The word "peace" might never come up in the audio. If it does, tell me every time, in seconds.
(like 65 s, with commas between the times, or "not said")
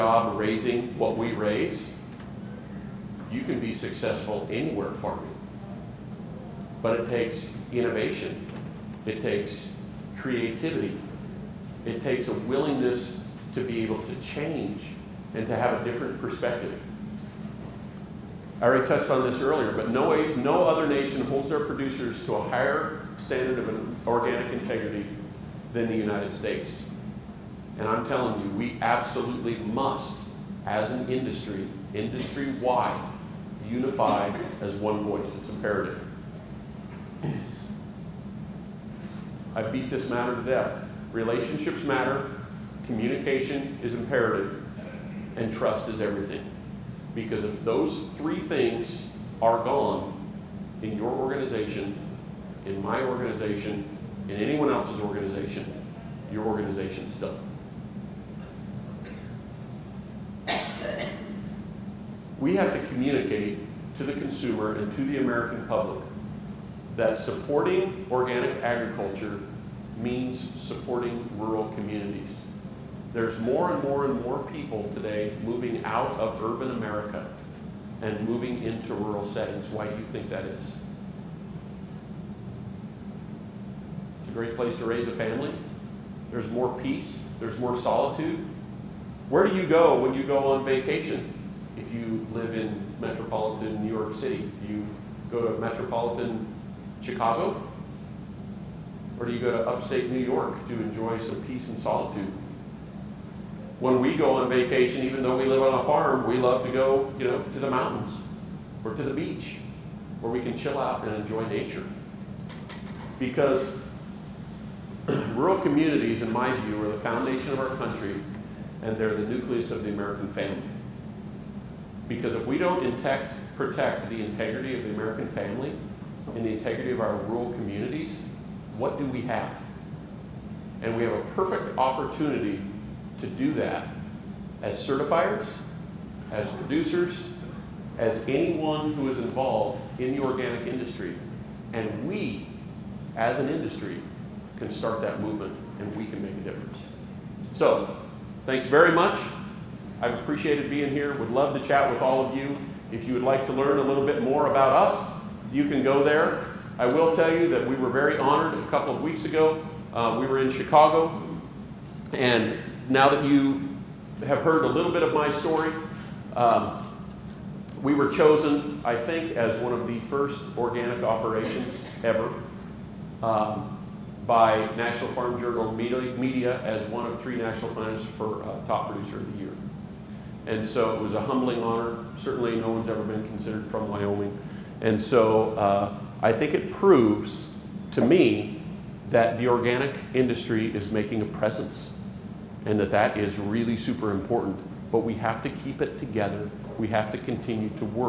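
86 s, 101 s.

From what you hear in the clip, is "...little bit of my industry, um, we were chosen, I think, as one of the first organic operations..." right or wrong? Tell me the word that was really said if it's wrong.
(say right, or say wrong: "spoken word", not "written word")
wrong: "story", not "industry".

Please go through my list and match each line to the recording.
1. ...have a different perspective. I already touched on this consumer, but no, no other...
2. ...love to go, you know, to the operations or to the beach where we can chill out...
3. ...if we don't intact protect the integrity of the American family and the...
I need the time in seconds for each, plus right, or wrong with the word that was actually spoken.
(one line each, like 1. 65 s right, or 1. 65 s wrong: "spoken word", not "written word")
1. 15 s wrong: "earlier", not "consumer"
2. 106 s wrong: "mountains", not "operations"
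3. 122 s right.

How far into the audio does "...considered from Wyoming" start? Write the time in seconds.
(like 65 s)
183 s.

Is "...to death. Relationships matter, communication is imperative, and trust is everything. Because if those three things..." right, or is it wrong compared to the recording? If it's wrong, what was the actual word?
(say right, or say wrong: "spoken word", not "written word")
right.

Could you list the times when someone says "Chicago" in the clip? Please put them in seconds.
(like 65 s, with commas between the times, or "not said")
97 s, 160 s.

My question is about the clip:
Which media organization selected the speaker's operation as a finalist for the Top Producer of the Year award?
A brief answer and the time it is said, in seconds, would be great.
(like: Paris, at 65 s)
National Farm Journal Media, at 174 s.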